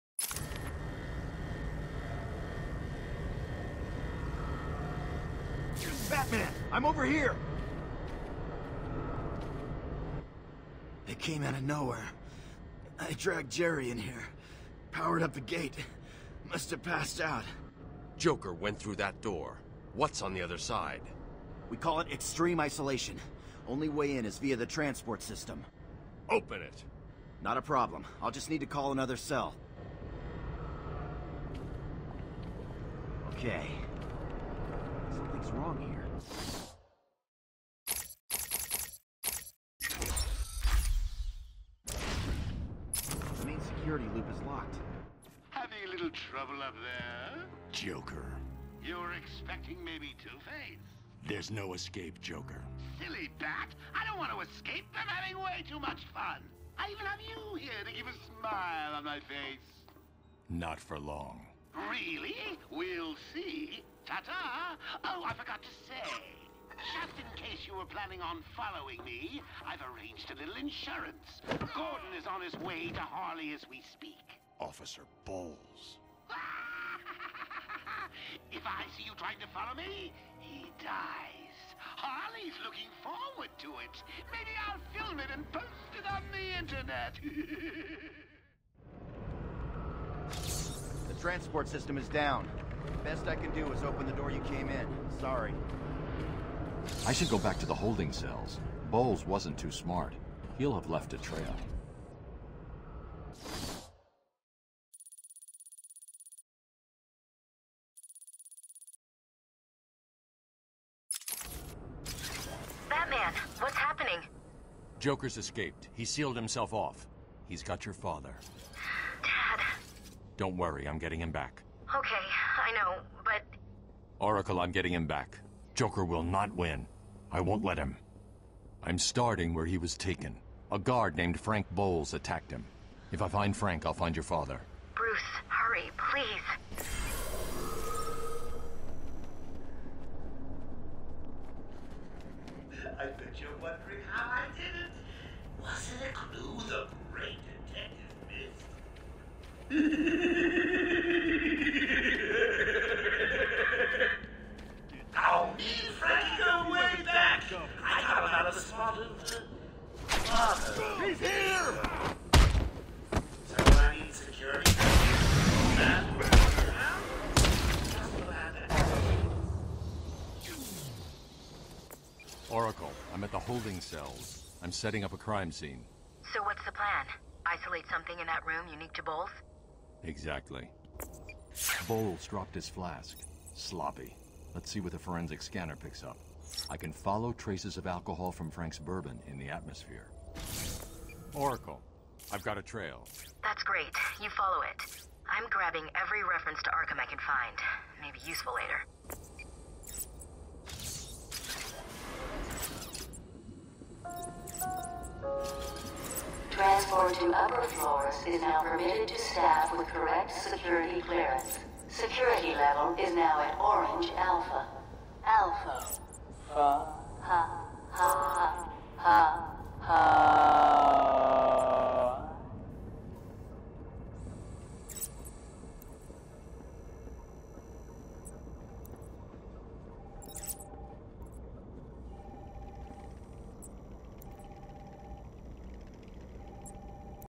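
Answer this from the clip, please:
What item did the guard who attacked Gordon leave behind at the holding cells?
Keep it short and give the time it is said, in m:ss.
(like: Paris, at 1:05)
His flask, at 3:02.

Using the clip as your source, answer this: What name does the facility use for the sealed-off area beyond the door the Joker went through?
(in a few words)
Extreme isolation.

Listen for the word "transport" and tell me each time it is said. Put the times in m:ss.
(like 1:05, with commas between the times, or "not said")
0:24, 1:31.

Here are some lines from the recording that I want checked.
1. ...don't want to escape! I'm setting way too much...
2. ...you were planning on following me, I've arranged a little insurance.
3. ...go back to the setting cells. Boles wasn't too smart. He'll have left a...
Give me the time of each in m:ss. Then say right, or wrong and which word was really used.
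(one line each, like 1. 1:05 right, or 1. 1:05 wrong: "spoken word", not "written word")
1. 0:54 wrong: "having", not "setting"
2. 1:07 right
3. 1:37 wrong: "holding", not "setting".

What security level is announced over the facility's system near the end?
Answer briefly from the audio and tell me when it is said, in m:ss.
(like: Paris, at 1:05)
Orange alpha, at 3:33.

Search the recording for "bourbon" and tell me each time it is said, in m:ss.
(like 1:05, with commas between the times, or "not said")
3:08.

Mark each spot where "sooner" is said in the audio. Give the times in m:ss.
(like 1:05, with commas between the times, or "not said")
not said.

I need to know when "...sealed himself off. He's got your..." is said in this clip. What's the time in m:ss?
1:56.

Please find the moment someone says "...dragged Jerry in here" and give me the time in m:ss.
0:13.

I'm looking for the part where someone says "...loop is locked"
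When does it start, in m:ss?
0:44.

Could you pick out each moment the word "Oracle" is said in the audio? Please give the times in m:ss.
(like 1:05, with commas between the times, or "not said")
2:04, 2:52, 3:11.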